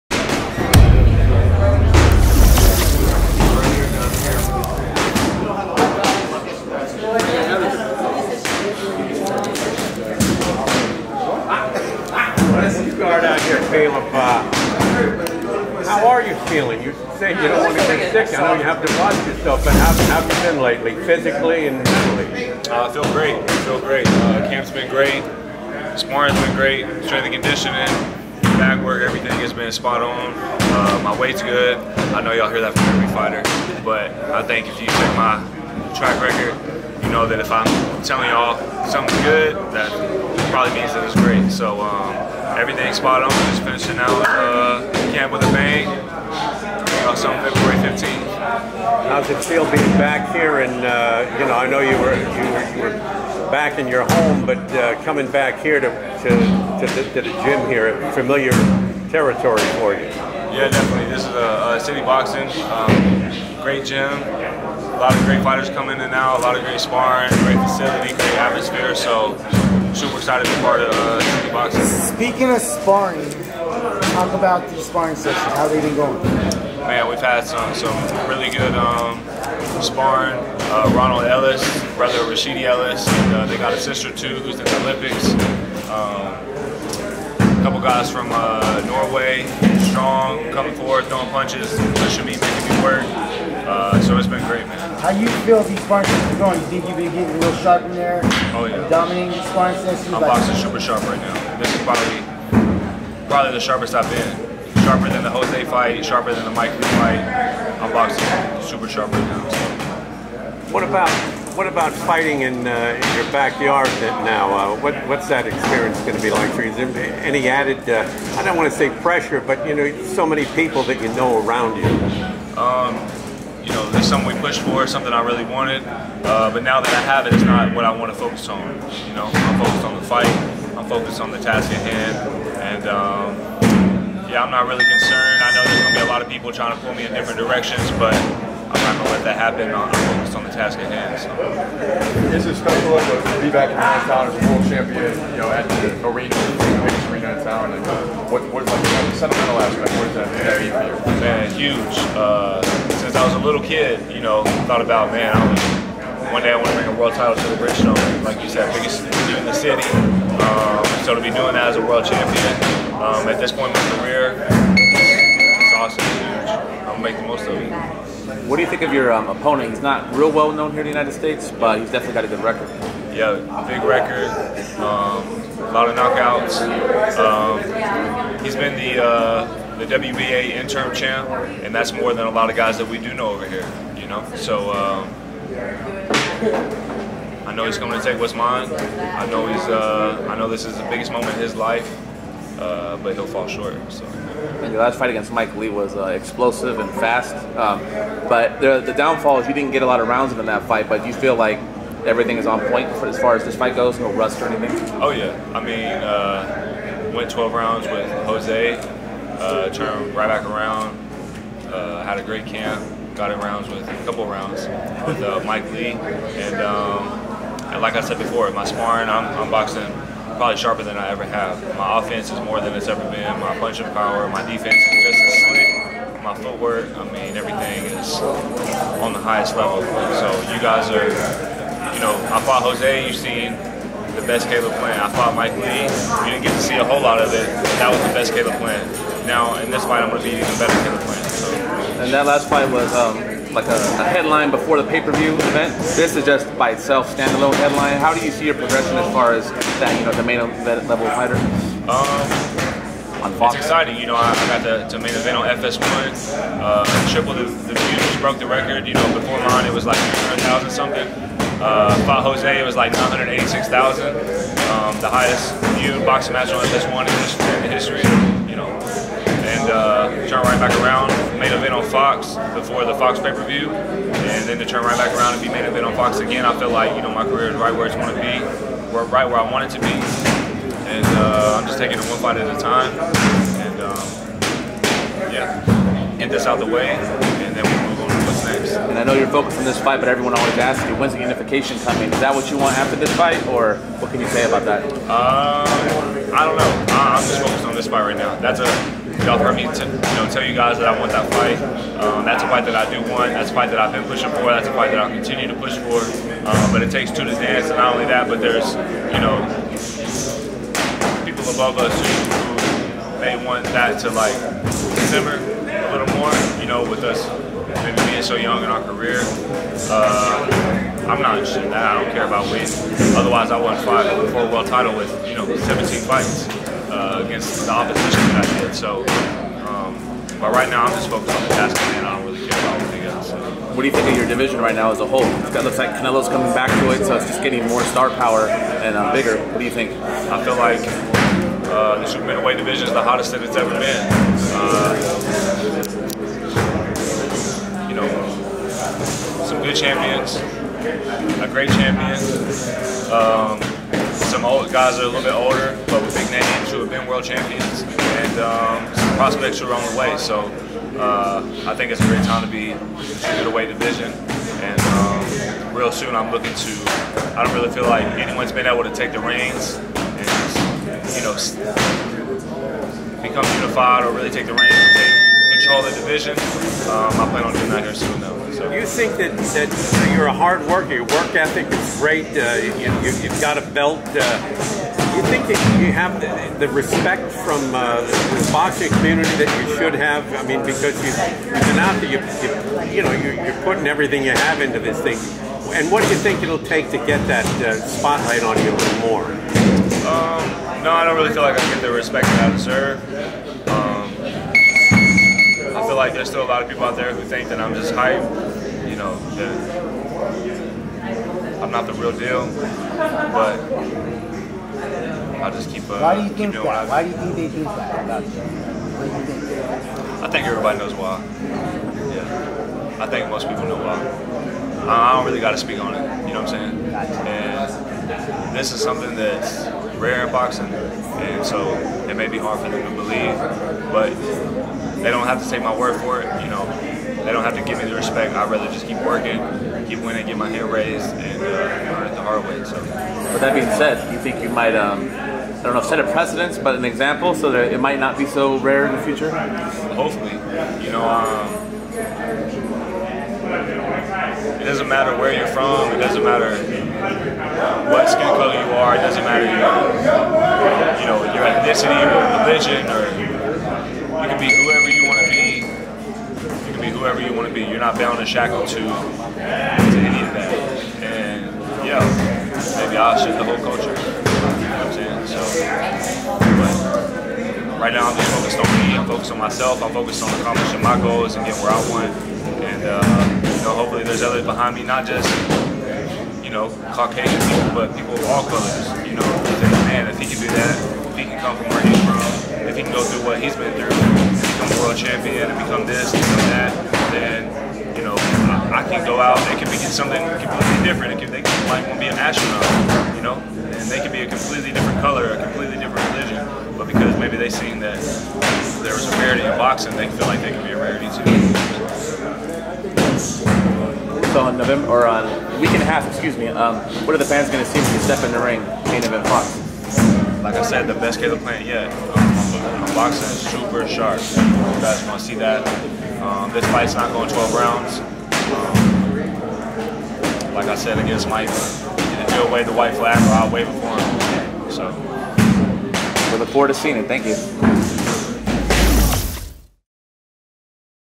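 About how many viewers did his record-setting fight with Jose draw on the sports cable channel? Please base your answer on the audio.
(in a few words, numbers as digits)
986,000.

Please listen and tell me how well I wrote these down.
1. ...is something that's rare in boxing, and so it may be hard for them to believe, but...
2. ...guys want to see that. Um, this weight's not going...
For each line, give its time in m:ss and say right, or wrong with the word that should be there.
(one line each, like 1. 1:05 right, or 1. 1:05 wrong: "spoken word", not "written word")
1. 7:08 right
2. 8:44 wrong: "fight", not "weight".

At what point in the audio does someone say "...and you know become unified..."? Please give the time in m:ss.
6:09.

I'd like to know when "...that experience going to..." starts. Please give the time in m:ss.
1:55.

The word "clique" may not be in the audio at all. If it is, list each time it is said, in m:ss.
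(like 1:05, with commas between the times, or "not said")
not said.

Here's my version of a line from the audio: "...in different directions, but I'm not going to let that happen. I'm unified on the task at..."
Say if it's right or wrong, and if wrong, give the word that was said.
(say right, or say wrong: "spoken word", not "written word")
wrong: "focused", not "unified".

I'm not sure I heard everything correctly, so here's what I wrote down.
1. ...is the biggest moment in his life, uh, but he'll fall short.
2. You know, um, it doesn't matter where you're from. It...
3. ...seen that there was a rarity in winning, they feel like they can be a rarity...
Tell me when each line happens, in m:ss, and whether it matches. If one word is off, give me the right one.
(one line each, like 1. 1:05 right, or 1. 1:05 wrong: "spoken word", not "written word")
1. 3:10 right
2. 7:30 right
3. 8:27 wrong: "boxing", not "winning".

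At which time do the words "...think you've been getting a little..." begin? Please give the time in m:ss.
1:36.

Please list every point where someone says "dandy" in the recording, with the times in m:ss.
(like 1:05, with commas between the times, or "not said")
not said.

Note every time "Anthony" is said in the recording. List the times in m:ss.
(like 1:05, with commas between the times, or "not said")
not said.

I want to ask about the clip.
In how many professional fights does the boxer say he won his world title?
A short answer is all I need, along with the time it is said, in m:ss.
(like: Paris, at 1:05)
17, at 5:25.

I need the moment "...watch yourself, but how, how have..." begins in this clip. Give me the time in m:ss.
0:18.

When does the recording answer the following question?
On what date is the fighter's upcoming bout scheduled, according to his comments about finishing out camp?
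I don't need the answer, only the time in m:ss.
0:47.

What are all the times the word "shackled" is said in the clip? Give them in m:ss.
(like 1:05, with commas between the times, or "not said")
7:48.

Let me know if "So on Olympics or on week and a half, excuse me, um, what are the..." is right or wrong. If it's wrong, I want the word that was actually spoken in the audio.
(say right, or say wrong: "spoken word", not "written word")
wrong: "November", not "Olympics".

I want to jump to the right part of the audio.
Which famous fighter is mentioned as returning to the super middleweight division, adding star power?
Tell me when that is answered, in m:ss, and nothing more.
5:35.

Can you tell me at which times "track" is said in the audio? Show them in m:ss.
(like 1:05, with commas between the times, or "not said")
0:35.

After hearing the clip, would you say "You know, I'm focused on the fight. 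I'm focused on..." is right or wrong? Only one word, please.
right.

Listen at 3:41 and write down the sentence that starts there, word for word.
My offense is more than it's ever been.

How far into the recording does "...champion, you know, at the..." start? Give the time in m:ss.
2:24.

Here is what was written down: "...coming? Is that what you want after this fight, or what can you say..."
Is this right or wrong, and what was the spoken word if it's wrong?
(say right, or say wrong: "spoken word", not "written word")
right.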